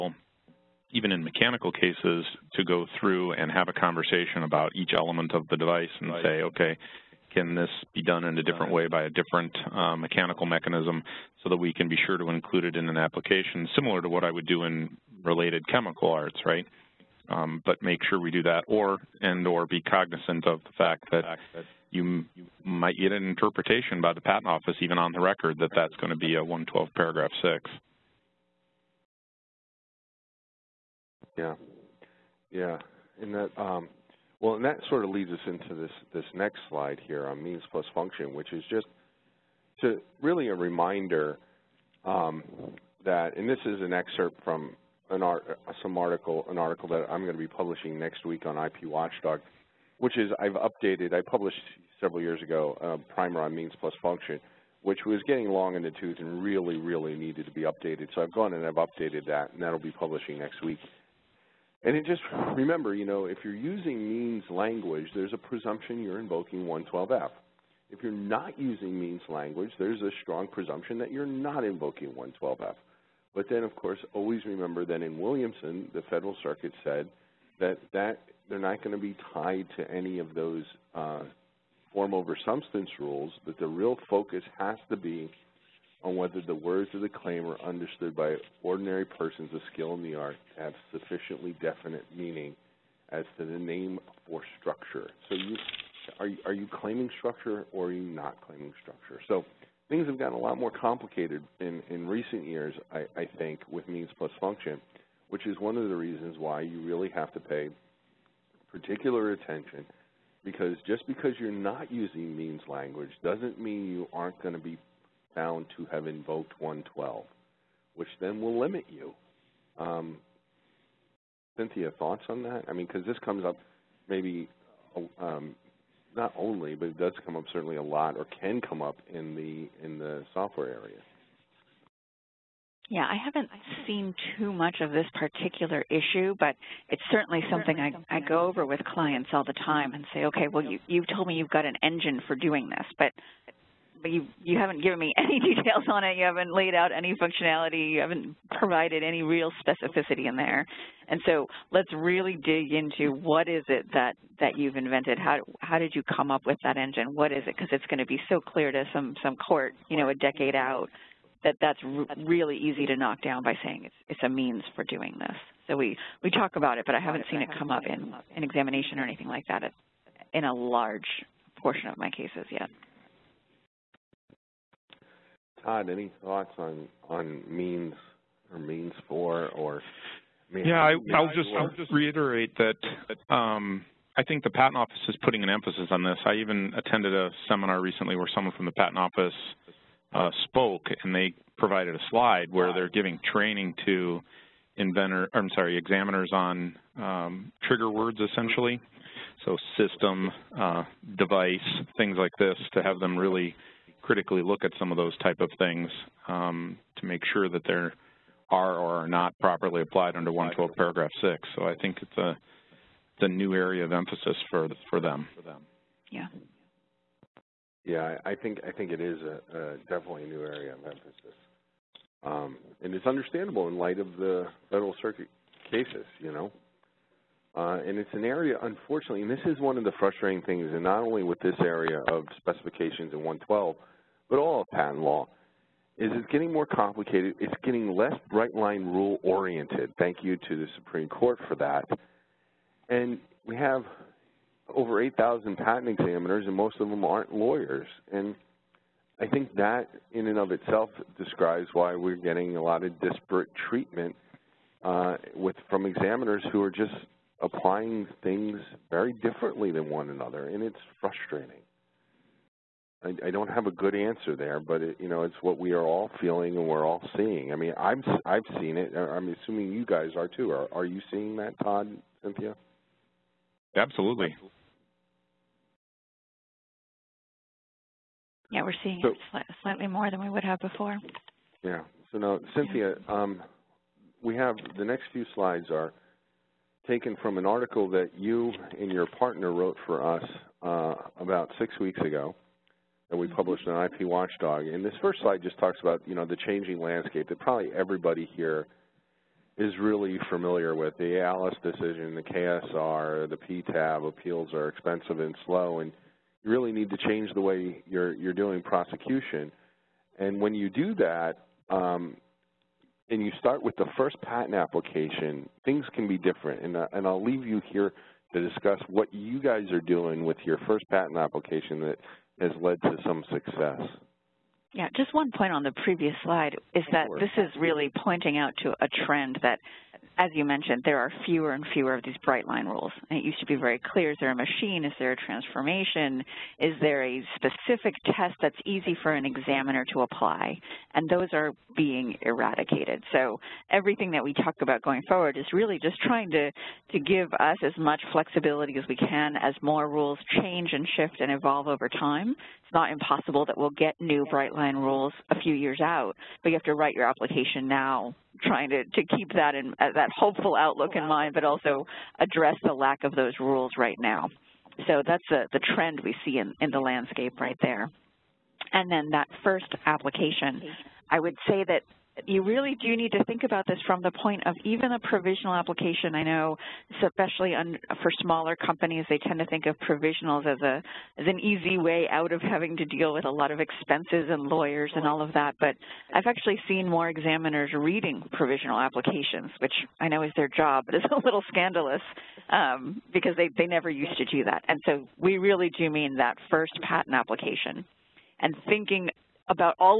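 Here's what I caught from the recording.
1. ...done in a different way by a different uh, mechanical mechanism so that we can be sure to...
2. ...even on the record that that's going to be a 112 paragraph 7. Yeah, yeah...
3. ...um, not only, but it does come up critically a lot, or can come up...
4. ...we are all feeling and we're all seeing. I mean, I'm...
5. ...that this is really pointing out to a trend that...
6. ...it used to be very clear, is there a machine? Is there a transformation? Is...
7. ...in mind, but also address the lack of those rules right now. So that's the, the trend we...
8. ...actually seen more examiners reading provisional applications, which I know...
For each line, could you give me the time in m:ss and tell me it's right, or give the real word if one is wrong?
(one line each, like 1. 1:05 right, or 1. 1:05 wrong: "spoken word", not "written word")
1. 0:08 right
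2. 0:24 wrong: "6", not "7"
3. 2:05 wrong: "certainly", not "critically"
4. 4:25 right
5. 5:26 right
6. 5:33 right
7. 6:00 right
8. 6:26 right.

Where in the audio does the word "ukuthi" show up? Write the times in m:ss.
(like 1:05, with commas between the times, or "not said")
not said.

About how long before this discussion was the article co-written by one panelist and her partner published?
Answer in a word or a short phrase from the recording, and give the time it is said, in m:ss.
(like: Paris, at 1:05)
six weeks ago, at 4:51.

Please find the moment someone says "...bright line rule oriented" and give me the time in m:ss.
3:58.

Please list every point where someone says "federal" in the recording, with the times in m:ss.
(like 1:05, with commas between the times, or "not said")
1:16, 3:44.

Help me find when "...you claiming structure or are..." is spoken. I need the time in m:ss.
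1:36.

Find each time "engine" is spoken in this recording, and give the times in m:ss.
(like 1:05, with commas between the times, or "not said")
2:21, 2:36.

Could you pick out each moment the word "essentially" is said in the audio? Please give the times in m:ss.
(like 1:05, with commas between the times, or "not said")
3:18.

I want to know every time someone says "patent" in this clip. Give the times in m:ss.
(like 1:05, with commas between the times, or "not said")
0:24, 3:04, 3:08, 3:54, 4:05, 5:14, 5:20, 6:36.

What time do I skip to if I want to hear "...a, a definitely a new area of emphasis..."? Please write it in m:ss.
3:39.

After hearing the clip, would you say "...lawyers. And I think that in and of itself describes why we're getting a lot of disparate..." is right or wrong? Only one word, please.
right.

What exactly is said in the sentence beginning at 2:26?
You haven't laid out any functionality.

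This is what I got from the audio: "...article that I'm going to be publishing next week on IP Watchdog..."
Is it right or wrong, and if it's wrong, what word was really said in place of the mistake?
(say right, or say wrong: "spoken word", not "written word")
right.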